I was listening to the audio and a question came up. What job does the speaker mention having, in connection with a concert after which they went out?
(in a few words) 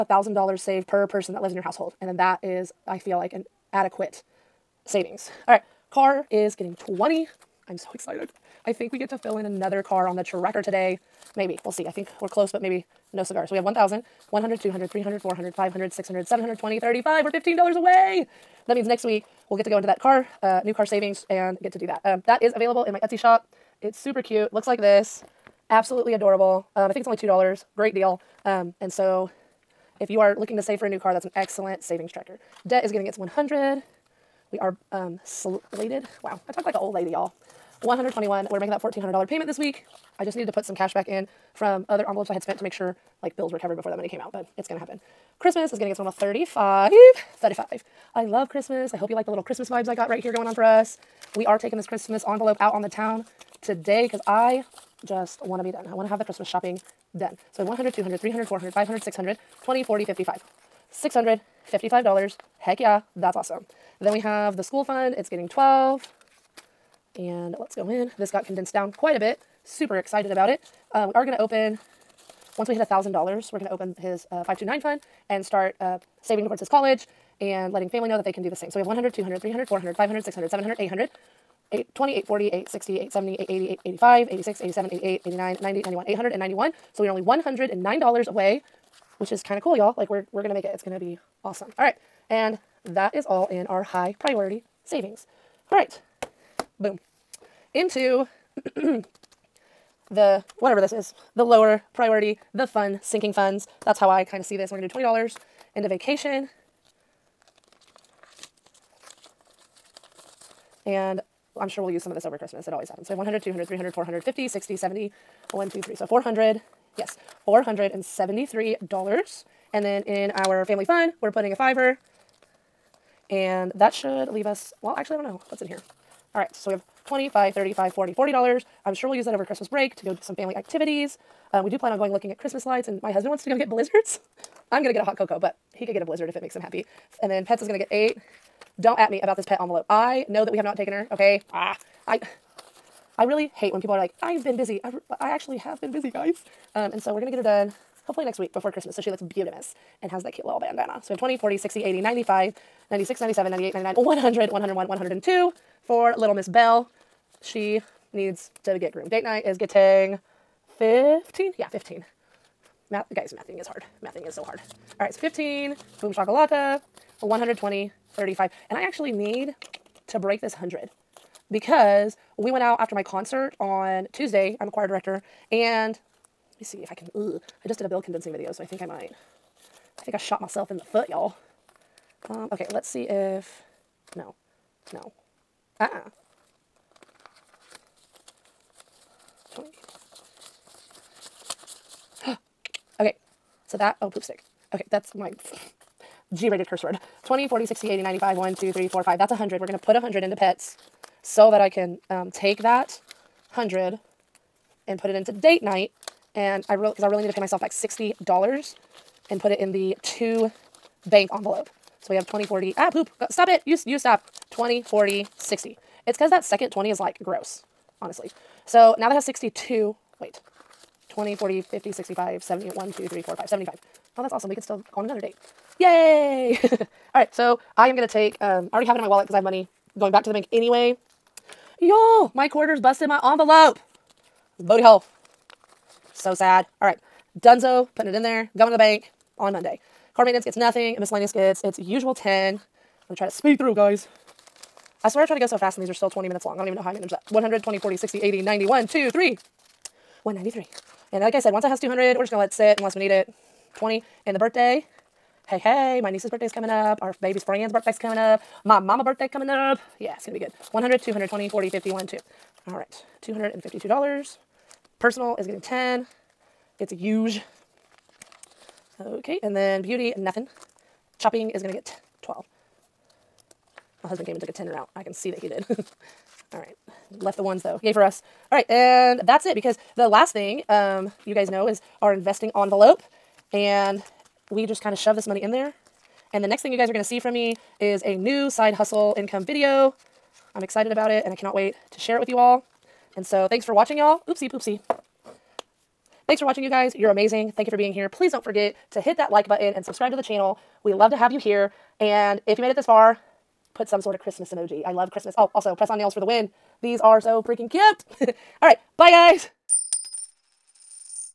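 Choir director.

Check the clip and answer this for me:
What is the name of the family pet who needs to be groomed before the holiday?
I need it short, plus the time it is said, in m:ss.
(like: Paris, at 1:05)
Bell, at 2:36.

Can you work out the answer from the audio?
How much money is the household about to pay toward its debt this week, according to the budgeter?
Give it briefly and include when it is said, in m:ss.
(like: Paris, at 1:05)
$1,400, at 0:38.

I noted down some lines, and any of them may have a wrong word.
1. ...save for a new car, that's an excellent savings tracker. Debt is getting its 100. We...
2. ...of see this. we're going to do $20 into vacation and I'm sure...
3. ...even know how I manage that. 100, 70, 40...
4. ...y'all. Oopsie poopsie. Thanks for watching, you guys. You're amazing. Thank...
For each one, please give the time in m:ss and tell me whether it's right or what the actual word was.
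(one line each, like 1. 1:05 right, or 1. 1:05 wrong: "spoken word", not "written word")
1. 0:30 right
2. 1:44 right
3. 4:06 wrong: "20", not "70"
4. 4:53 right.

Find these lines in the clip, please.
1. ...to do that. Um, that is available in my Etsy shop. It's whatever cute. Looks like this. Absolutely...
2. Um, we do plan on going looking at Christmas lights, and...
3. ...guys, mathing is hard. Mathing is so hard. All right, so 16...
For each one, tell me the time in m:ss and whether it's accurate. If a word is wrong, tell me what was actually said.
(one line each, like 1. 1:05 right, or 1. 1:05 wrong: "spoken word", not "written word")
1. 0:21 wrong: "super", not "whatever"
2. 2:11 right
3. 2:43 wrong: "15", not "16".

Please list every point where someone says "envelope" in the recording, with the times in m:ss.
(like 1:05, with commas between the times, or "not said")
0:42, 0:52, 2:19, 3:31, 3:53, 4:42.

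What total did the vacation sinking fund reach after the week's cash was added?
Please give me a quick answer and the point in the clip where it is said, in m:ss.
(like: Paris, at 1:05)
$473, at 1:57.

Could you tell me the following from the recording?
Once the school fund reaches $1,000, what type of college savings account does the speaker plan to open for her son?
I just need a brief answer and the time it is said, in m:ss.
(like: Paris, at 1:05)
529 fund, at 1:14.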